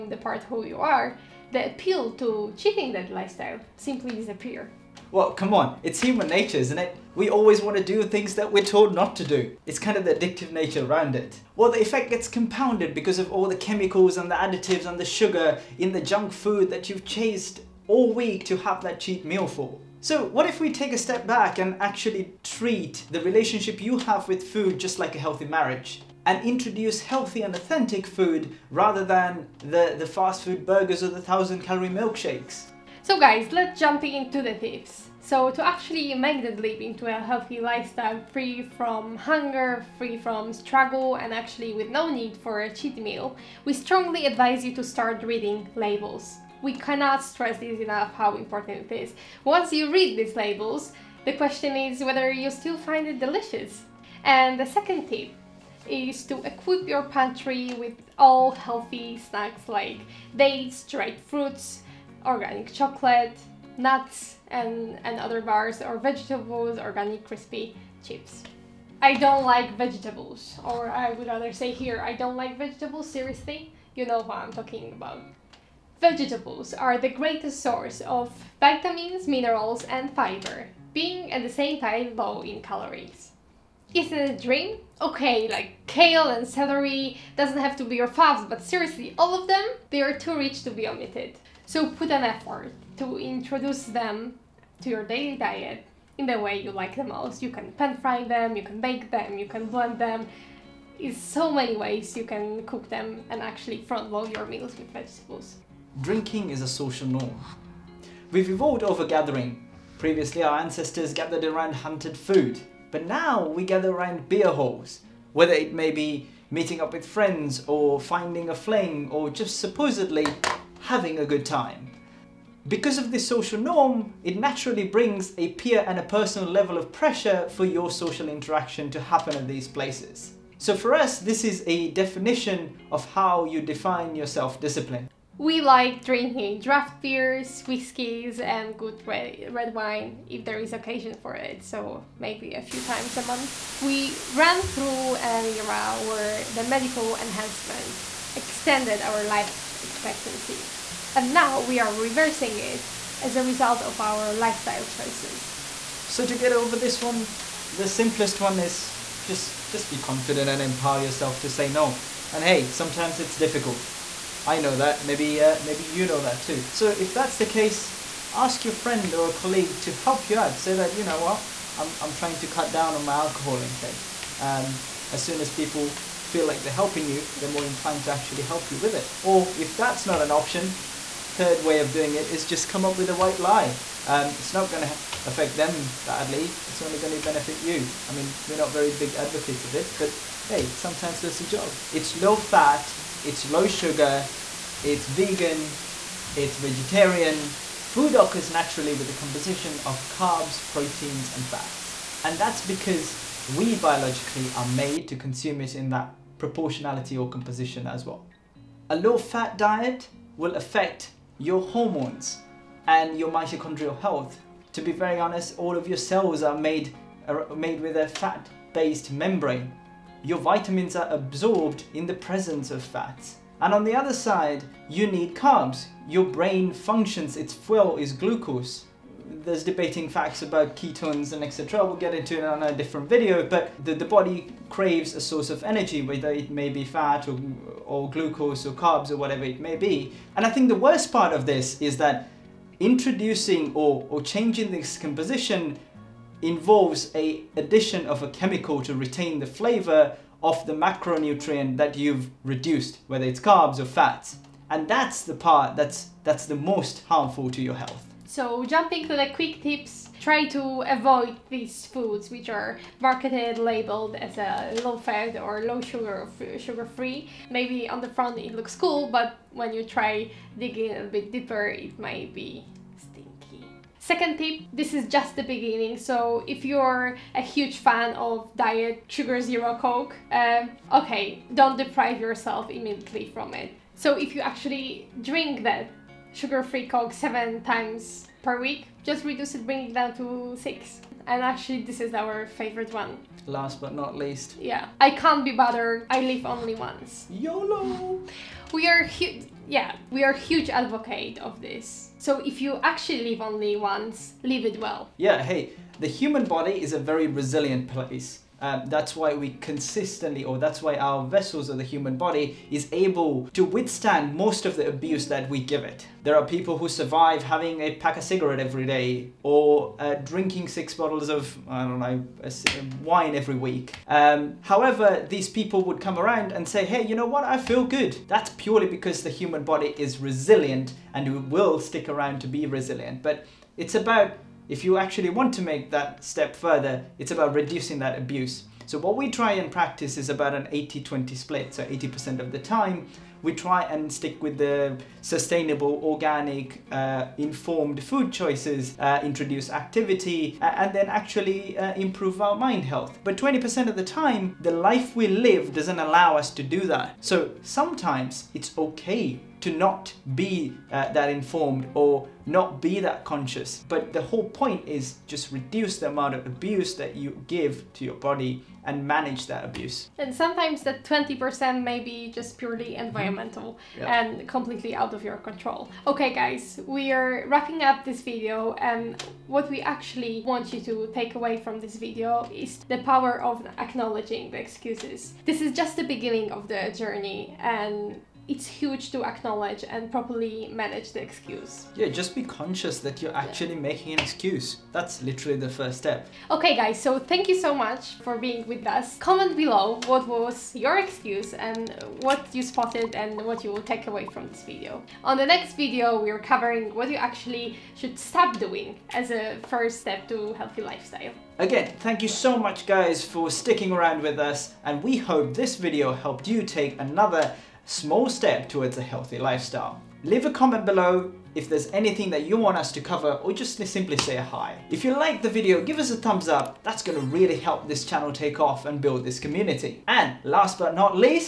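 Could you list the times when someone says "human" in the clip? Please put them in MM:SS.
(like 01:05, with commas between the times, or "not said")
00:06, 05:06, 05:11, 05:29.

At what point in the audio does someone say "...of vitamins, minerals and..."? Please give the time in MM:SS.
01:18.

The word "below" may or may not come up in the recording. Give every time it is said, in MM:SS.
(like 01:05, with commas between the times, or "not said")
06:39, 07:00.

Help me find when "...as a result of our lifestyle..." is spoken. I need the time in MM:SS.
02:33.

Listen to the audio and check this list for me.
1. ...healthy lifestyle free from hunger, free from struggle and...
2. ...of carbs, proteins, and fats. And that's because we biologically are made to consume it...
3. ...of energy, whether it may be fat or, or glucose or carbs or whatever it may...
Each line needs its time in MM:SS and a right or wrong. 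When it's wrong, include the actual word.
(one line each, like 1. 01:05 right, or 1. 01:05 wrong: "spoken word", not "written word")
1. 00:37 right
2. 03:19 right
3. 03:55 right.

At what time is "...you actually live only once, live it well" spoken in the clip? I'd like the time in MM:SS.
05:02.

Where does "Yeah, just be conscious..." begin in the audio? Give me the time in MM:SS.
06:31.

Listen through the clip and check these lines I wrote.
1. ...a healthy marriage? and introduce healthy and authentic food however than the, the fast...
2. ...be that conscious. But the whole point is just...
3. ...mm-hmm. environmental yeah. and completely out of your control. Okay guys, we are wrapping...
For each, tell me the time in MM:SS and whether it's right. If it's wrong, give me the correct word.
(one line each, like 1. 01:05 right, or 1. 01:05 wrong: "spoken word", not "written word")
1. 00:25 wrong: "rather", not "however"
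2. 06:02 right
3. 06:12 right.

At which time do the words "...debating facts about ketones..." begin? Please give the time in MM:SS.
03:49.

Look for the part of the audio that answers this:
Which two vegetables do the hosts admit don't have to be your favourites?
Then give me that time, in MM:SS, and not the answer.
01:25.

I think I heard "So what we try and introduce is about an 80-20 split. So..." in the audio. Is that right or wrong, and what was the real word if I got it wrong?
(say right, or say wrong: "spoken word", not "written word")
wrong: "practice", not "introduce".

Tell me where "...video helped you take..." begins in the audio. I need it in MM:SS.
06:55.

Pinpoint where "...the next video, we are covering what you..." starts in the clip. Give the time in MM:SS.
06:45.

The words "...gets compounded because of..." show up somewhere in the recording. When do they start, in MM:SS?
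00:12.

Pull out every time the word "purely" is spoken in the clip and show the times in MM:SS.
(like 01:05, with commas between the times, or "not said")
05:28, 06:12.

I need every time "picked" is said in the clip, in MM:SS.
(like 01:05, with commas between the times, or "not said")
not said.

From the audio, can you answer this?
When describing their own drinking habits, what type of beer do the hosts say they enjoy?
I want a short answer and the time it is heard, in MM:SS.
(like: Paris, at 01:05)
Draft beers, at 02:16.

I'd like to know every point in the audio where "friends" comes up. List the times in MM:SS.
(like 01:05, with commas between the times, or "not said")
01:57, 02:48.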